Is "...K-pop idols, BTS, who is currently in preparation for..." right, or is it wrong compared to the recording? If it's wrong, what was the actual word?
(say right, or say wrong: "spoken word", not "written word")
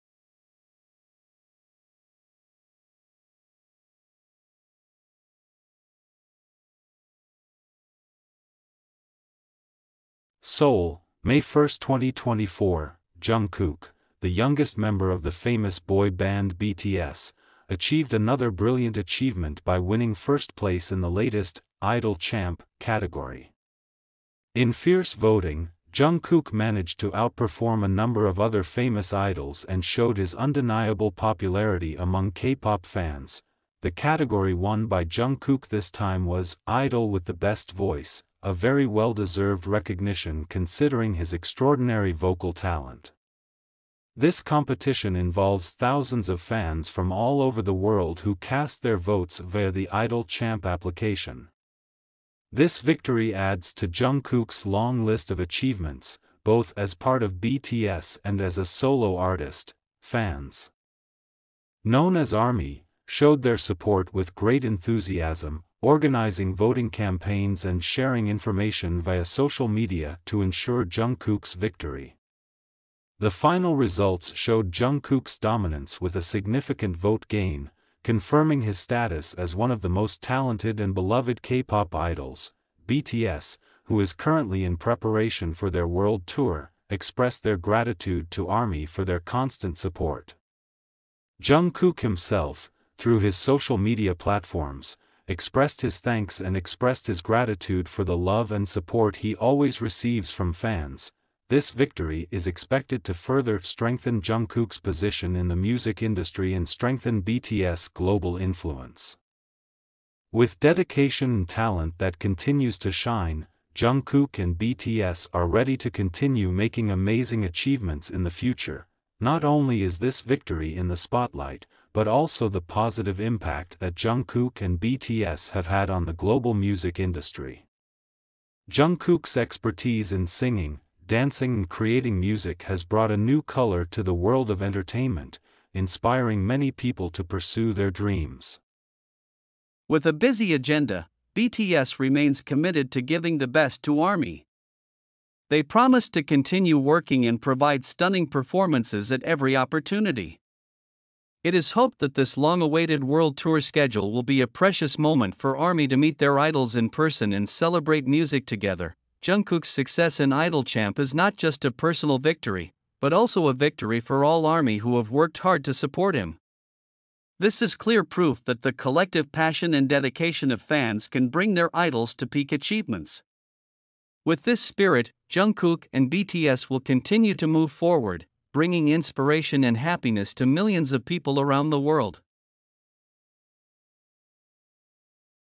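right.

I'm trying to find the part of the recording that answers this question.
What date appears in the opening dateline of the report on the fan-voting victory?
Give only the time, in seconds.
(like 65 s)
11 s.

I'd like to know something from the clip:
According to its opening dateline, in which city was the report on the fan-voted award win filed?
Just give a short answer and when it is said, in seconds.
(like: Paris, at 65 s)
Seoul, at 10 s.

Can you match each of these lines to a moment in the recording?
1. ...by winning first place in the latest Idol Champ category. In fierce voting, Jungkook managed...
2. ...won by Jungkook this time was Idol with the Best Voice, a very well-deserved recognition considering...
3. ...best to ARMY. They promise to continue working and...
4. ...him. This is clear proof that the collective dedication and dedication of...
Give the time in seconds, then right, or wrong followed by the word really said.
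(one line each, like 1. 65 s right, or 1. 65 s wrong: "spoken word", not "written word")
1. 19 s right
2. 34 s right
3. 143 s right
4. 166 s wrong: "passion", not "dedication".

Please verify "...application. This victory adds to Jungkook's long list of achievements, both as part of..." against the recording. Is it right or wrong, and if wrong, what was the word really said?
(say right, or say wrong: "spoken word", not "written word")
right.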